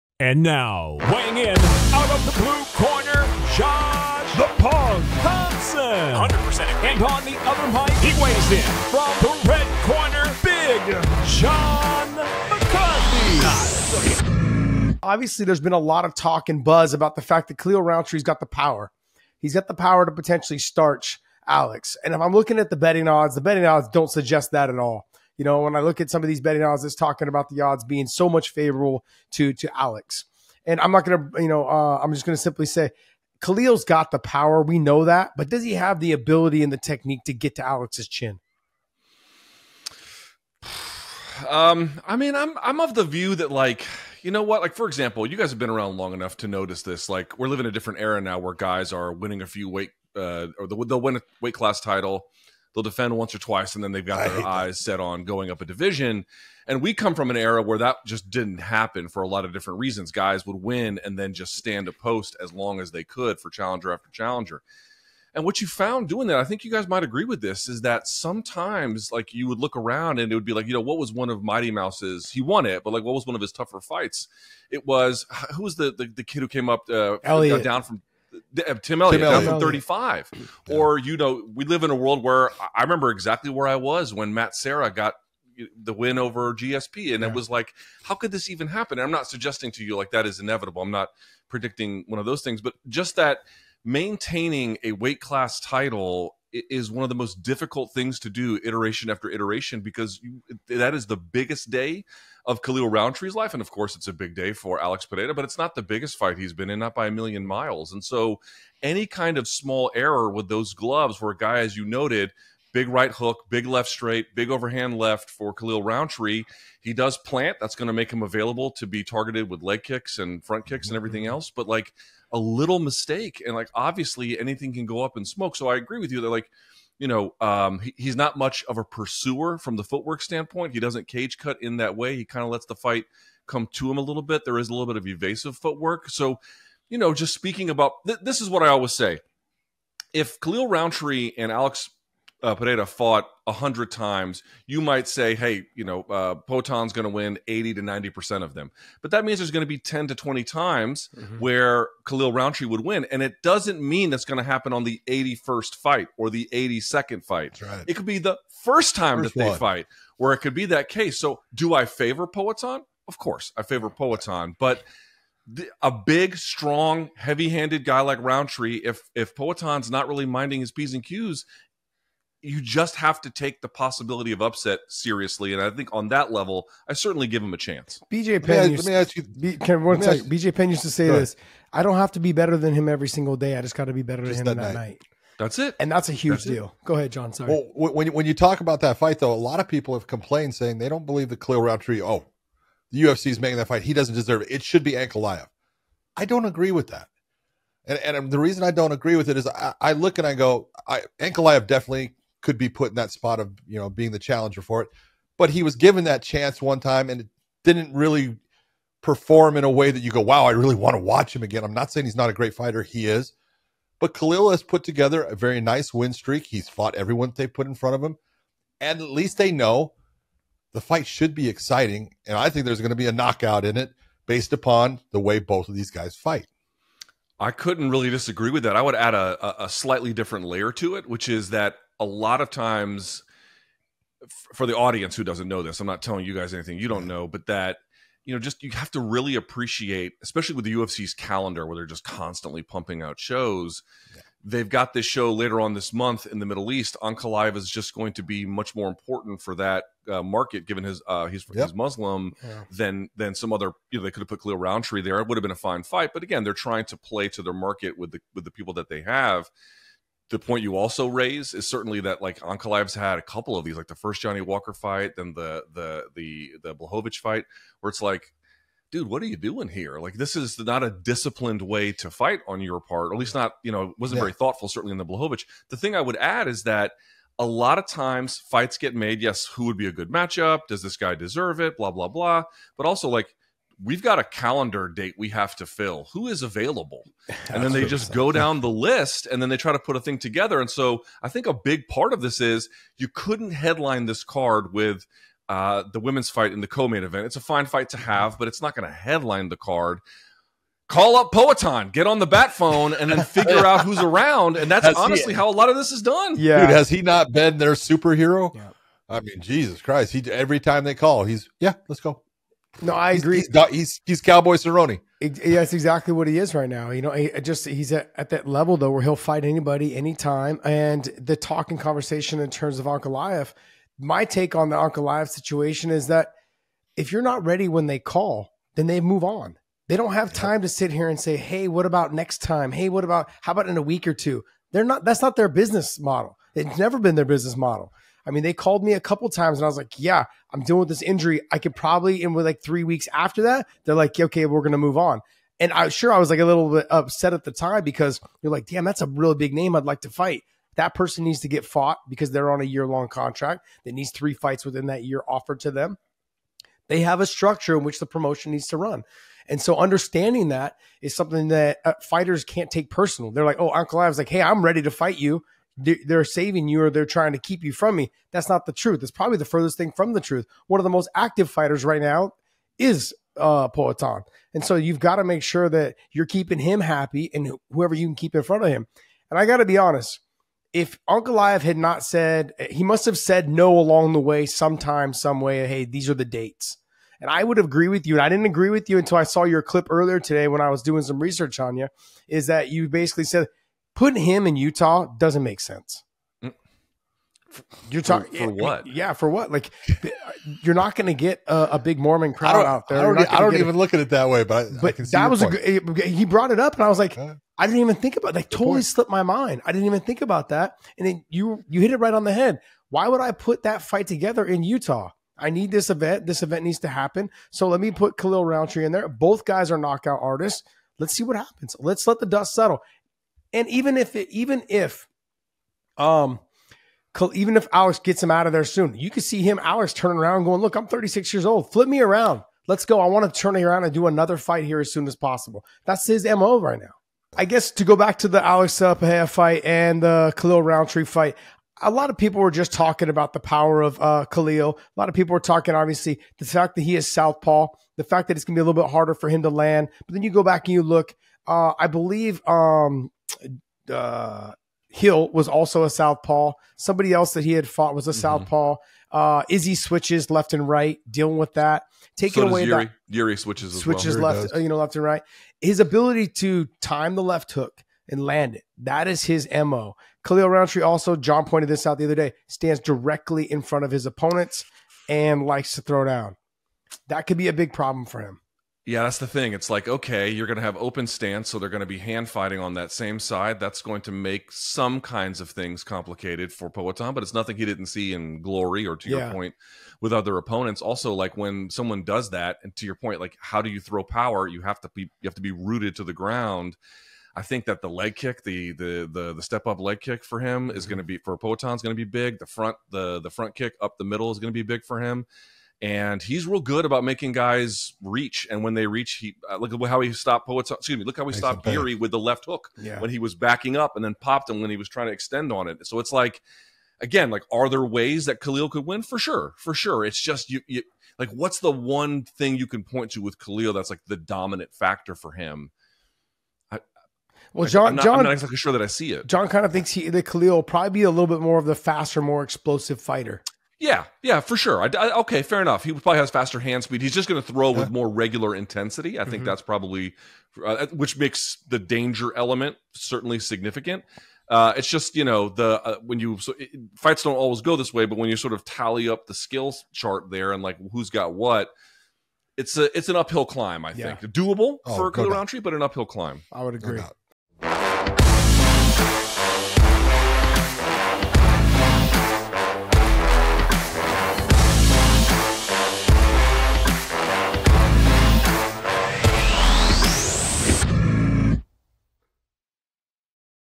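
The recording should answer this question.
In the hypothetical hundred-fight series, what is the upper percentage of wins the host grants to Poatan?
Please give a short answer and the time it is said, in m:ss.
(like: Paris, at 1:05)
90%, at 2:27.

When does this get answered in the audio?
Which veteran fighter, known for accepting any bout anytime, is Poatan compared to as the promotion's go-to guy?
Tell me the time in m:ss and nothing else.
5:14.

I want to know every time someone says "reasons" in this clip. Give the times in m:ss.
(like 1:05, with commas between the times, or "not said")
0:59, 3:18.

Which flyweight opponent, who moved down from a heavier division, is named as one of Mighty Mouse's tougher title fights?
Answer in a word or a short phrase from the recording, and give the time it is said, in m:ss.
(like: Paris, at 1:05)
Tim Elliott, at 1:18.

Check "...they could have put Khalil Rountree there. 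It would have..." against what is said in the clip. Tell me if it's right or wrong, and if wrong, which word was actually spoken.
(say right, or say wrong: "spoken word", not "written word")
right.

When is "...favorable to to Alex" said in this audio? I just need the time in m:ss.
0:28.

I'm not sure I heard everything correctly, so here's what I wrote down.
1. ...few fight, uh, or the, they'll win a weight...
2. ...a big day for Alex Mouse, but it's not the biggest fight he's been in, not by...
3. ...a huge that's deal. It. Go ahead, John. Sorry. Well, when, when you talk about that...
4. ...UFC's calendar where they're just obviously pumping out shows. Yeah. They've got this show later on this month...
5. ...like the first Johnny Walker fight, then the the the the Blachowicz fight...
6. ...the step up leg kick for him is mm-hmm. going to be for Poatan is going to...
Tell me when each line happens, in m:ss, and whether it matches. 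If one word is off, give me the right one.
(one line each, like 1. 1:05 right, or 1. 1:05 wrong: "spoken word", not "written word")
1. 0:49 wrong: "weight", not "fight"
2. 1:44 wrong: "Pereira", not "Mouse"
3. 3:06 right
4. 4:00 wrong: "constantly", not "obviously"
5. 4:23 right
6. 8:19 right.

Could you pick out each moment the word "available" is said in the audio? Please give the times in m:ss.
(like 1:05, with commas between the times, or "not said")
1:58, 4:46.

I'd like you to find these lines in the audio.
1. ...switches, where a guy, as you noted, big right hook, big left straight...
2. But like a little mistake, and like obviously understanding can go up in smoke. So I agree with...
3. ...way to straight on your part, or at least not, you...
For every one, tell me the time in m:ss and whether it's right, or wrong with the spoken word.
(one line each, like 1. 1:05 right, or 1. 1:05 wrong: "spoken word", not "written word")
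1. 1:50 wrong: "gloves", not "switches"
2. 2:01 wrong: "anything", not "understanding"
3. 4:31 wrong: "fight", not "straight".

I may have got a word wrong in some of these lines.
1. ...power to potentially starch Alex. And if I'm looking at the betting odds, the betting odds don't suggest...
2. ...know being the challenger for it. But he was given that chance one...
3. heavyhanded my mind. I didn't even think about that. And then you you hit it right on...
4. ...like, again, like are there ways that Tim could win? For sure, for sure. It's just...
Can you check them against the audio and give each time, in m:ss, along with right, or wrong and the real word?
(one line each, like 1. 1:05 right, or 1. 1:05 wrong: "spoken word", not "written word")
1. 0:19 right
2. 3:23 right
3. 6:48 wrong: "slipped", not "heavyhanded"
4. 8:36 wrong: "Khalil", not "Tim".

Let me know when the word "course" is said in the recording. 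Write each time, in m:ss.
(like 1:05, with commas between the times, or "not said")
1:43, 2:43.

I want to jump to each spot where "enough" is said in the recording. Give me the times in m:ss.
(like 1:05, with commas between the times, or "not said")
0:46, 8:55.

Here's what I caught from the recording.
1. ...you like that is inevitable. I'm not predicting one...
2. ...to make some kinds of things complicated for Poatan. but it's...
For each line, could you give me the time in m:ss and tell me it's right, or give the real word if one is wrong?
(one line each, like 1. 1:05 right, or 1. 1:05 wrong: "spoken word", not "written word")
1. 1:29 right
2. 8:04 right.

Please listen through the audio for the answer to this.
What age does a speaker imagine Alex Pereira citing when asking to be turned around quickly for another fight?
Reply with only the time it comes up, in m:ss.
7:10.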